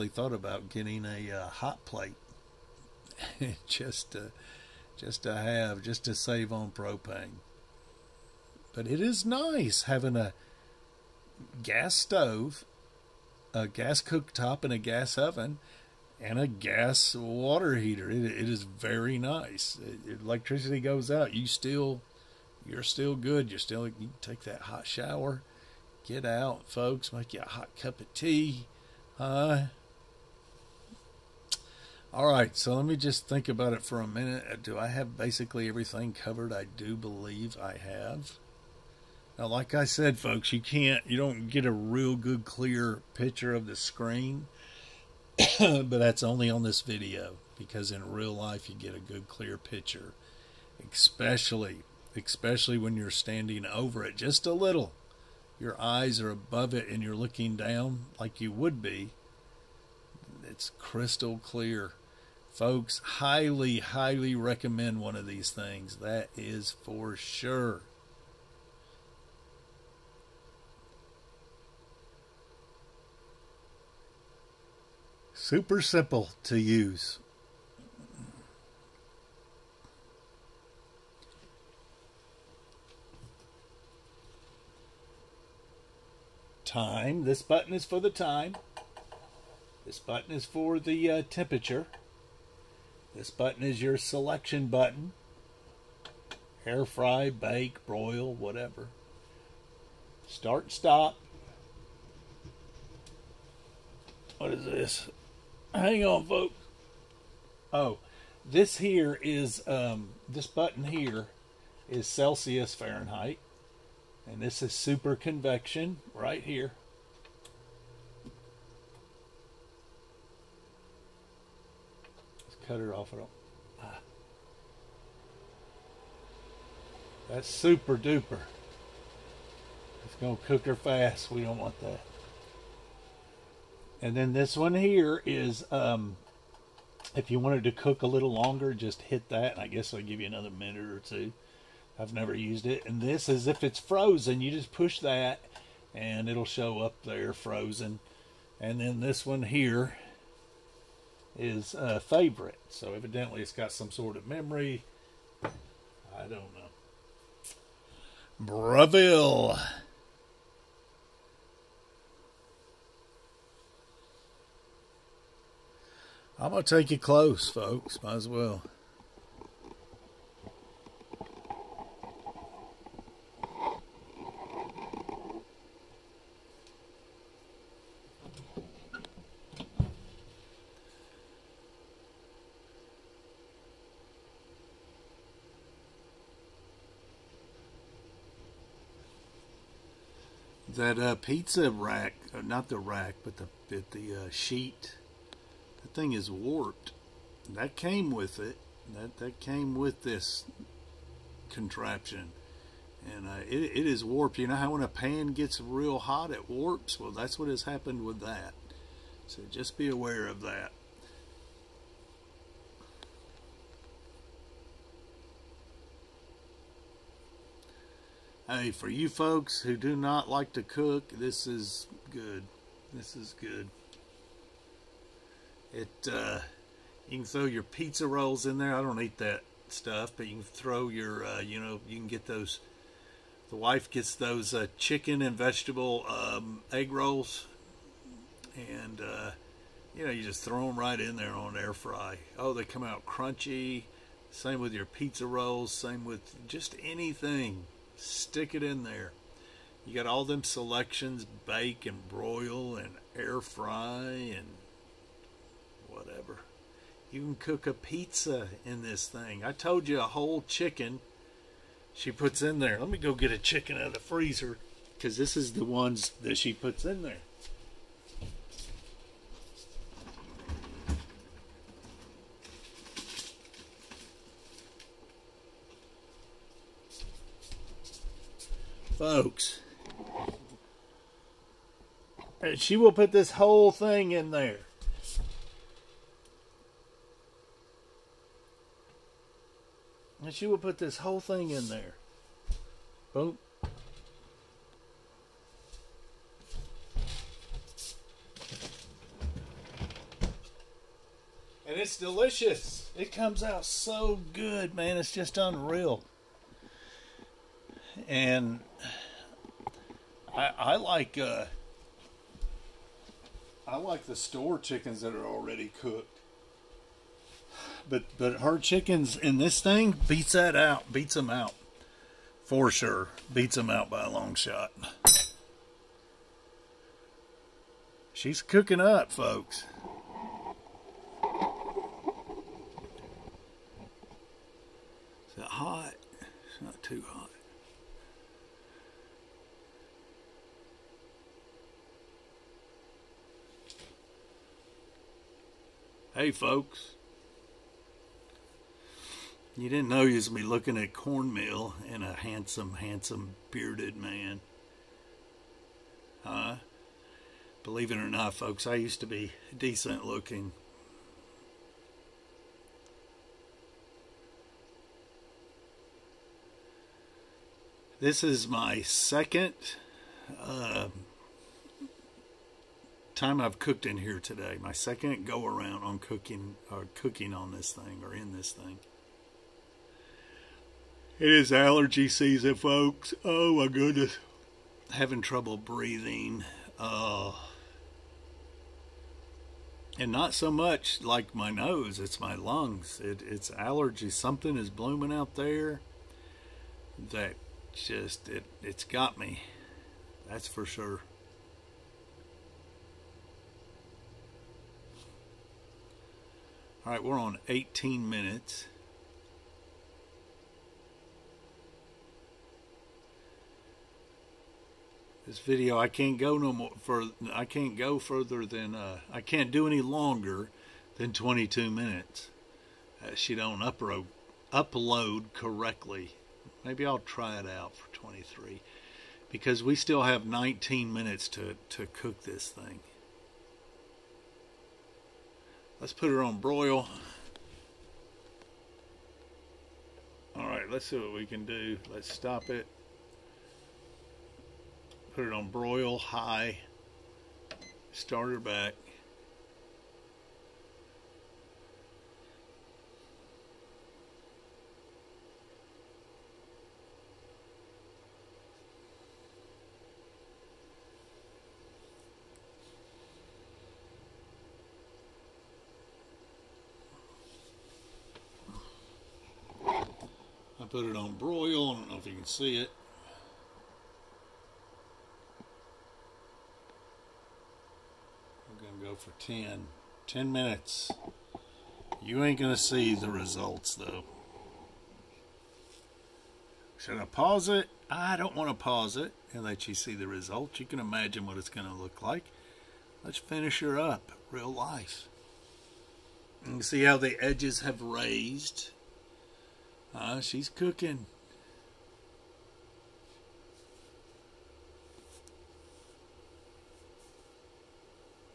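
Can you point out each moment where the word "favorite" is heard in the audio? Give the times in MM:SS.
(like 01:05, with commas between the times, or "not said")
02:31.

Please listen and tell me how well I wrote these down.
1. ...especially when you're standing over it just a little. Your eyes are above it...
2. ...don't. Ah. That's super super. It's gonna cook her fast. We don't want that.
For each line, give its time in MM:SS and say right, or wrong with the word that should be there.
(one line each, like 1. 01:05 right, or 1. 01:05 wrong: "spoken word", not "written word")
1. 00:52 right
2. 02:03 wrong: "duper", not "super".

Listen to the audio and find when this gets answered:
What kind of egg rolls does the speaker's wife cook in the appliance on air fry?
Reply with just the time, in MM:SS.
03:54.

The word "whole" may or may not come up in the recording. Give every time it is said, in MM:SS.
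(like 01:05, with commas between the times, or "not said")
04:20, 04:43, 04:50.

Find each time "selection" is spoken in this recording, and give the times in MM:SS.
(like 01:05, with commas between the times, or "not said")
01:33, 04:10.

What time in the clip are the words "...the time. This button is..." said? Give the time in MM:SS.
01:28.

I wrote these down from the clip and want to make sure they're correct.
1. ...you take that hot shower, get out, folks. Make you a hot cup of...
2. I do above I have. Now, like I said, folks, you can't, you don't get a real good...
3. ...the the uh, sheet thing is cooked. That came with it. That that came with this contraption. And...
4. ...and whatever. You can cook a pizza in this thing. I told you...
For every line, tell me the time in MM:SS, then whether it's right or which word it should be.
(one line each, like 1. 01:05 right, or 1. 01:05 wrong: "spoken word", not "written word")
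1. 00:23 right
2. 00:36 wrong: "believe", not "above"
3. 03:13 wrong: "warped", not "cooked"
4. 04:14 right.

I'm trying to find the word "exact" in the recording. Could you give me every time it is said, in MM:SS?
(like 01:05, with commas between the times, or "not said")
not said.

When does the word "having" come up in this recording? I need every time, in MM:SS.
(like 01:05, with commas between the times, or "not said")
00:09, 06:24.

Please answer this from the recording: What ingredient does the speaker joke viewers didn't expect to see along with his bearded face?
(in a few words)
cornmeal.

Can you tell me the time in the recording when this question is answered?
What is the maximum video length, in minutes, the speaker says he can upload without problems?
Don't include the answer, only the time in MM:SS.
07:01.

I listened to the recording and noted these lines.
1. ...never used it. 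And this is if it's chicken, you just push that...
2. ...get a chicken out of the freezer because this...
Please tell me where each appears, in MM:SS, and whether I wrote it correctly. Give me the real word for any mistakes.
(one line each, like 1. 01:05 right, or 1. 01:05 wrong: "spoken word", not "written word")
1. 02:22 wrong: "frozen", not "chicken"
2. 04:23 right.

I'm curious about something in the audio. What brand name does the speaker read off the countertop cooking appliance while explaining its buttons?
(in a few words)
Breville.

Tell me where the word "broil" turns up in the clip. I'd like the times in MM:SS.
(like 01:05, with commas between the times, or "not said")
01:37, 04:12, 07:16, 07:25, 07:51.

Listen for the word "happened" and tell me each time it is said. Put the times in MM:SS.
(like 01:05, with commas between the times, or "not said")
03:27.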